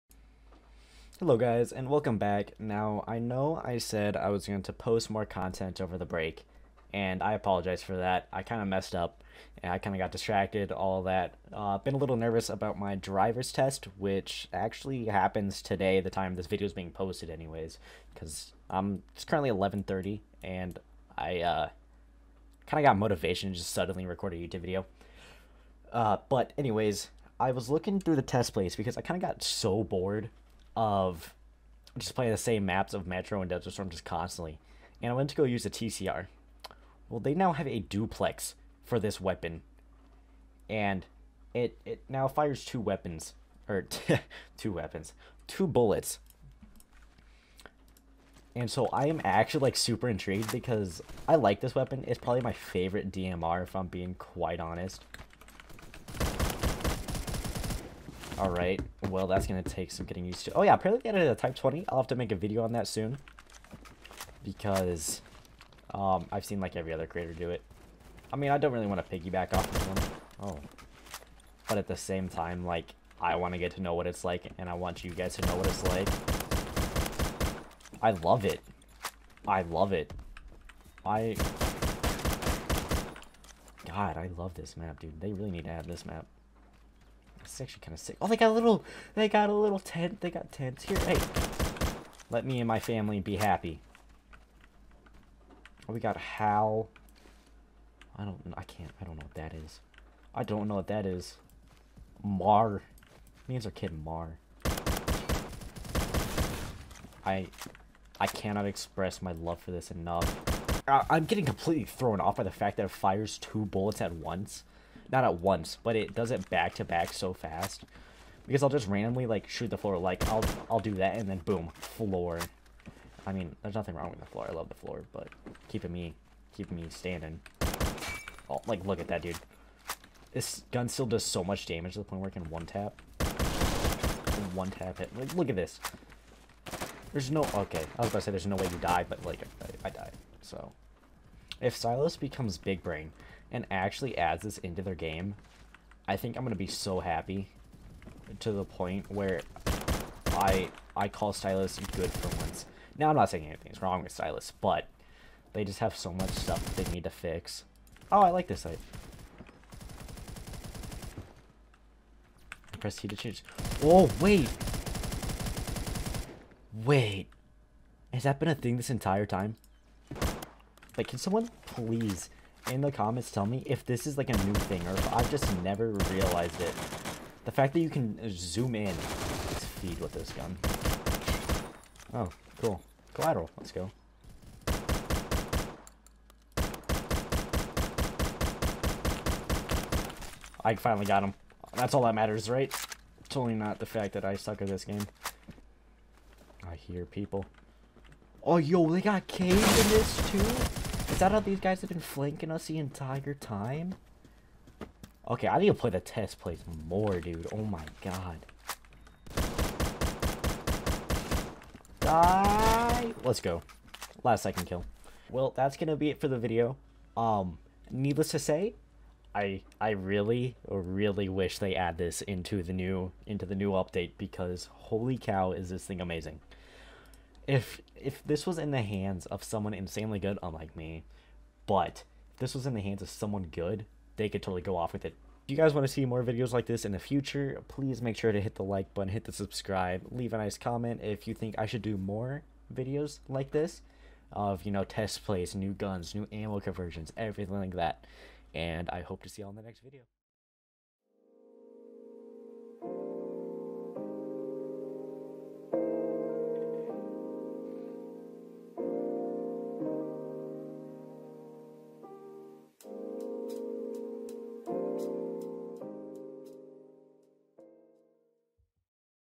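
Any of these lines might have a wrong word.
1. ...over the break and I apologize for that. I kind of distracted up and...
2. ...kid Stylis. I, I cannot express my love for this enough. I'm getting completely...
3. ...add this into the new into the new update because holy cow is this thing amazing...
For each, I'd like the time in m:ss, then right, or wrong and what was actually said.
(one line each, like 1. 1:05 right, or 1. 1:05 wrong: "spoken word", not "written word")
1. 0:05 wrong: "messed", not "distracted"
2. 1:43 wrong: "Mar", not "Stylis"
3. 3:41 right.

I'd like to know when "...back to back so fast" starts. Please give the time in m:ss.
1:56.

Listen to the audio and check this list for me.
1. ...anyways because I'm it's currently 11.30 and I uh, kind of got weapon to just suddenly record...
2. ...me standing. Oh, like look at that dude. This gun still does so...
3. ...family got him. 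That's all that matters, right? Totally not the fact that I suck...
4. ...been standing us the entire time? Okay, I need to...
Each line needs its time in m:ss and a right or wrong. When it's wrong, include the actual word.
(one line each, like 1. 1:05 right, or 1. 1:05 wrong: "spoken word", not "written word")
1. 0:17 wrong: "motivation", not "weapon"
2. 2:06 right
3. 3:10 wrong: "finally", not "family"
4. 3:21 wrong: "flanking", not "standing".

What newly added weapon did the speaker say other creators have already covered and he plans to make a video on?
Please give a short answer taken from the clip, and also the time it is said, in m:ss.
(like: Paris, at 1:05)
Type 20, at 1:01.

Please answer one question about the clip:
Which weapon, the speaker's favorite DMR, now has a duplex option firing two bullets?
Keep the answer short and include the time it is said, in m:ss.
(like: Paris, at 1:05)
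TCR, at 0:35.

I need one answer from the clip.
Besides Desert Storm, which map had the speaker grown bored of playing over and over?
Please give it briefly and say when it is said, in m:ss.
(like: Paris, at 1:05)
Metro, at 0:33.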